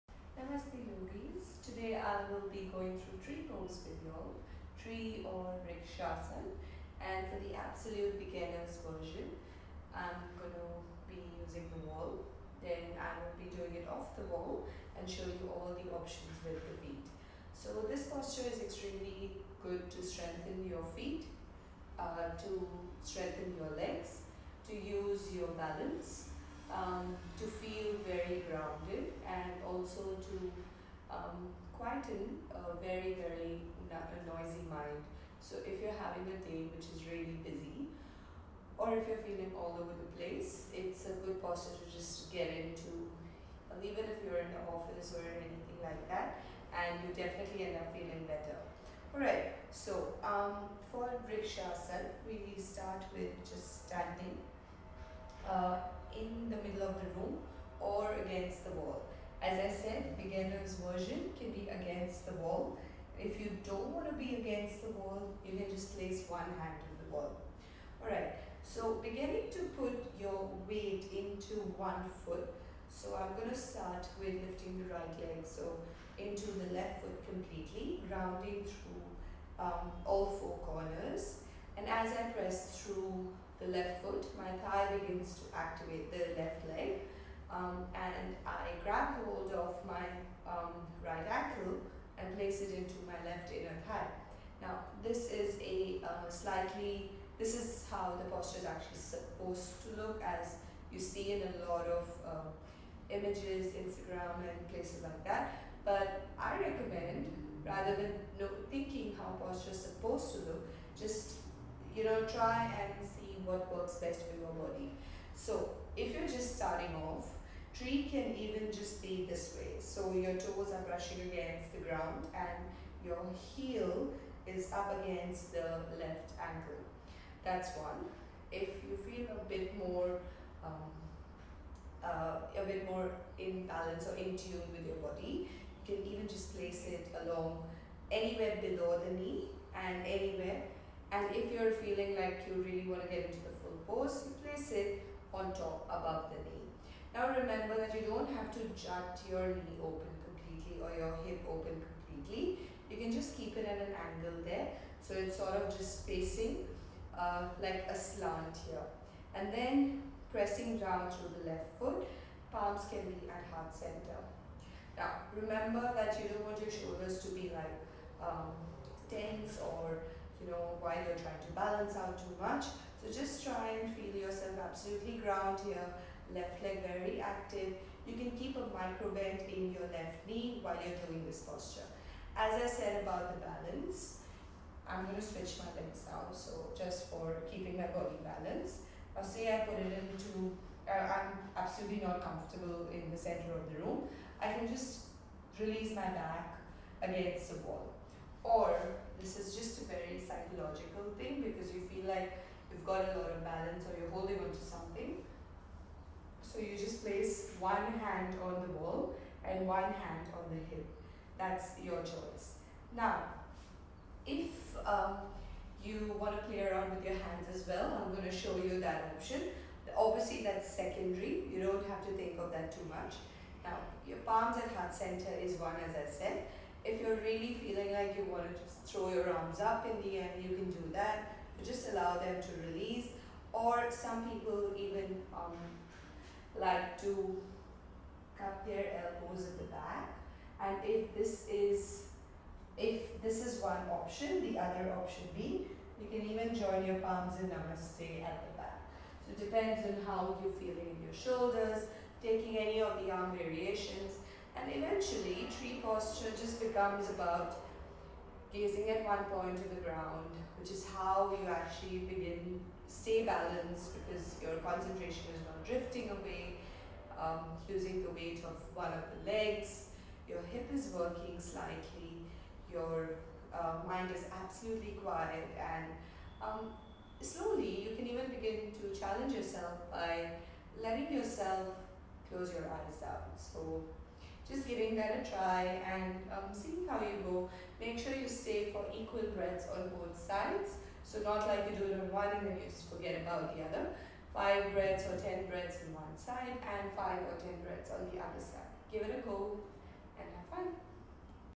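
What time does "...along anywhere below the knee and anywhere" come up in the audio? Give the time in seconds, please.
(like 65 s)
137 s.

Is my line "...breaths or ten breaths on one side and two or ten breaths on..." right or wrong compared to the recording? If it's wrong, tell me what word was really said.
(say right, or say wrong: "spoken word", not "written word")
wrong: "five", not "two".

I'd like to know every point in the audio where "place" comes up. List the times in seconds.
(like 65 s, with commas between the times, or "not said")
40 s, 65 s, 92 s, 104 s, 136 s, 144 s, 207 s.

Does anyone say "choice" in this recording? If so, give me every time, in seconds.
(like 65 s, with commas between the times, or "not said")
212 s.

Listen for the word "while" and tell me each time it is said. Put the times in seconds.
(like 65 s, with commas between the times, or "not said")
170 s, 180 s.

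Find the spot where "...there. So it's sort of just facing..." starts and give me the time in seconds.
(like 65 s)
154 s.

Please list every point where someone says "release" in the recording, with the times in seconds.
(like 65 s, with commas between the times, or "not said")
195 s, 232 s.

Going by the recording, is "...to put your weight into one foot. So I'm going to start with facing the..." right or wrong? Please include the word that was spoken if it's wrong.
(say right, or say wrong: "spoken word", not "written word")
wrong: "lifting", not "facing".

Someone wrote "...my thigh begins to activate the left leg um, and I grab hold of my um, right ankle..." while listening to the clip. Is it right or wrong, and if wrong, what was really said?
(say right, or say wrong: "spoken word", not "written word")
right.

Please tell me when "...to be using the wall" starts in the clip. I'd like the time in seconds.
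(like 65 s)
10 s.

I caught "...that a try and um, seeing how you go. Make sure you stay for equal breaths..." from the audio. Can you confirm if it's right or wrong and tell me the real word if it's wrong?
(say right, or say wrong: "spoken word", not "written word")
right.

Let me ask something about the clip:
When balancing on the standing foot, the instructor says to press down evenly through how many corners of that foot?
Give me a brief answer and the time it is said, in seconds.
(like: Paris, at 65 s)
4, at 80 s.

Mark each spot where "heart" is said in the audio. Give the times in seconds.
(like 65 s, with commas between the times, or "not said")
163 s, 224 s.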